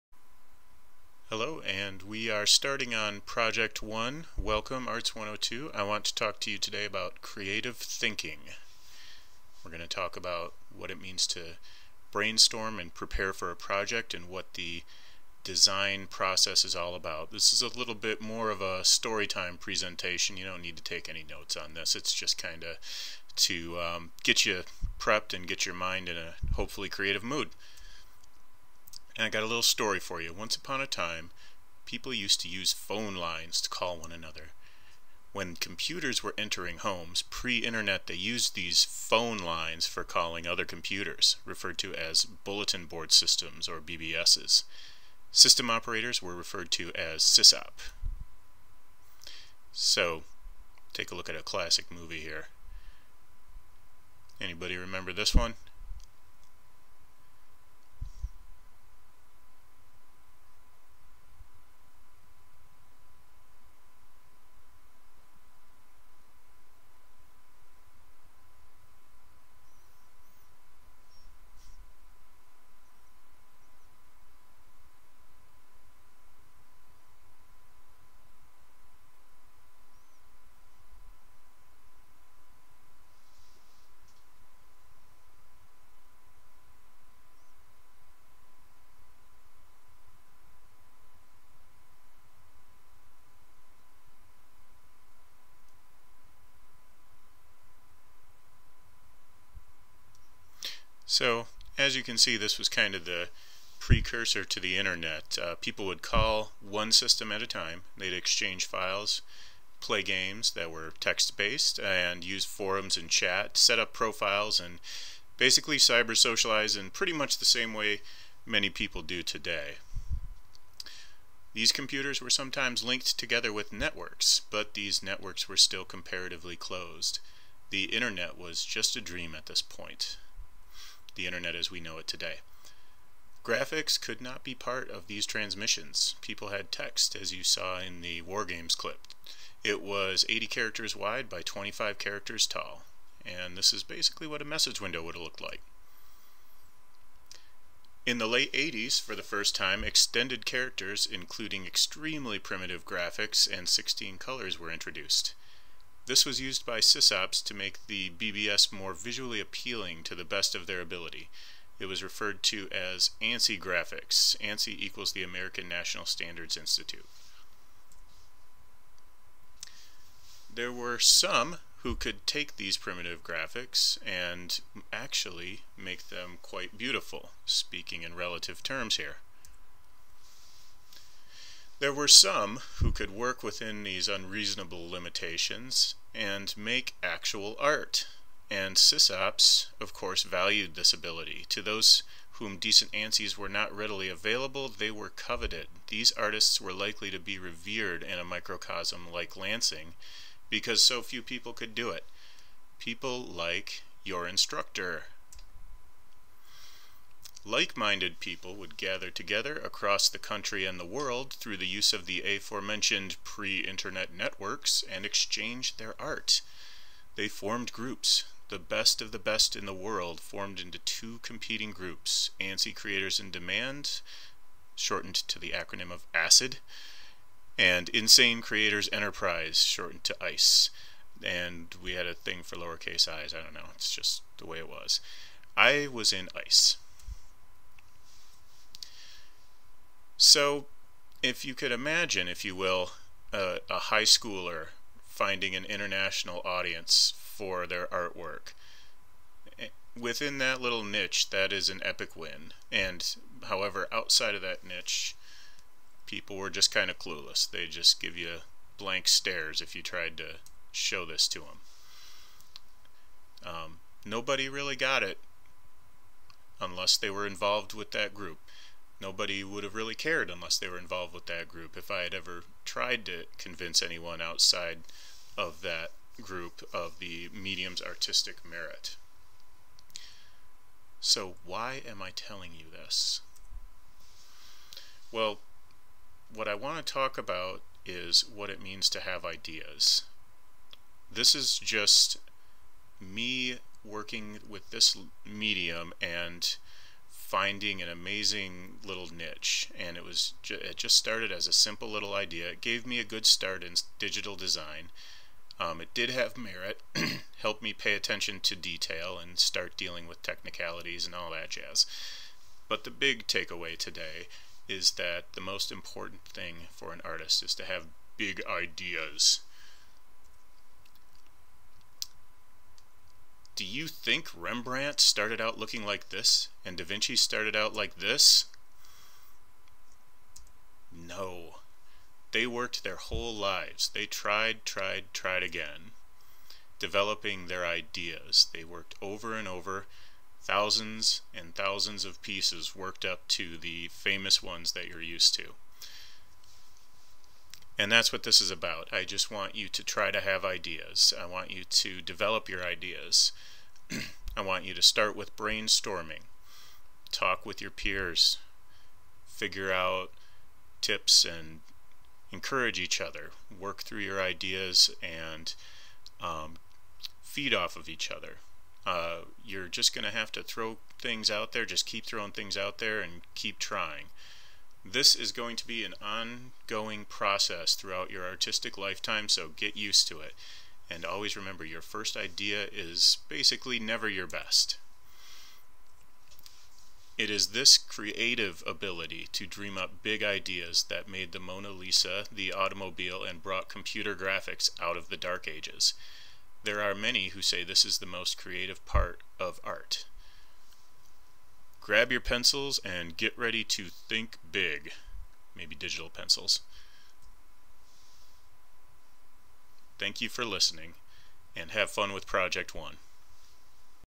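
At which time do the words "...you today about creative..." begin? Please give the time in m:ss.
0:06.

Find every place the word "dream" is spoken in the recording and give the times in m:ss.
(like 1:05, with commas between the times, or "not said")
2:09, 6:29.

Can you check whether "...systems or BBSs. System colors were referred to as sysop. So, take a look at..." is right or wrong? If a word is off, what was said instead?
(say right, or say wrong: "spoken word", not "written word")
wrong: "operators", not "colors".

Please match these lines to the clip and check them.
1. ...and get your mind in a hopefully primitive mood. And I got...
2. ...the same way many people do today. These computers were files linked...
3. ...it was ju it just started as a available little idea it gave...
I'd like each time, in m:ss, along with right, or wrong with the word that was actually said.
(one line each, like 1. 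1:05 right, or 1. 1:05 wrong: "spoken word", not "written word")
1. 0:25 wrong: "creative", not "primitive"
2. 1:57 wrong: "sometimes", not "files"
3. 4:59 wrong: "simple", not "available".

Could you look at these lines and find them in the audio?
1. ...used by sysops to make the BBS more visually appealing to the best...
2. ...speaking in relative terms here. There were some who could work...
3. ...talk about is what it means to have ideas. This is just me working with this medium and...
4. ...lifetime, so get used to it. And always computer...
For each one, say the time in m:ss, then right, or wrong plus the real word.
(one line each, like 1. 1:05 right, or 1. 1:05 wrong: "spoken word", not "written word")
1. 2:36 right
2. 2:57 right
3. 4:46 right
4. 6:18 wrong: "remember", not "computer".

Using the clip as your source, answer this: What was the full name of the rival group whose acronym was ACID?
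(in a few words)
ANSI Creators in Demand.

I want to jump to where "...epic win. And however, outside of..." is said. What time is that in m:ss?
4:11.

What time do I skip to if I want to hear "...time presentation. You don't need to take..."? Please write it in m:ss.
0:19.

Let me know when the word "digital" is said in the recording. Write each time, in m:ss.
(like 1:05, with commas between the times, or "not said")
5:03, 6:45.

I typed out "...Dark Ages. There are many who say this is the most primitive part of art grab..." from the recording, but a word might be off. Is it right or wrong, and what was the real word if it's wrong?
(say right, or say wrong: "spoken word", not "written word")
wrong: "creative", not "primitive".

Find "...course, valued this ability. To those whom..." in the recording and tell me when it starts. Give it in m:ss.
3:09.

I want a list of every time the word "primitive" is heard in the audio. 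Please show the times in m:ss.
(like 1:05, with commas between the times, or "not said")
2:32, 2:52.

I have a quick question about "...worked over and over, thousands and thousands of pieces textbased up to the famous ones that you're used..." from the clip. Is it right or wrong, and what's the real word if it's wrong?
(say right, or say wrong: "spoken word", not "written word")
wrong: "worked", not "textbased".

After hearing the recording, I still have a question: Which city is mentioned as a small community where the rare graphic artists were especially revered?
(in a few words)
Lansing.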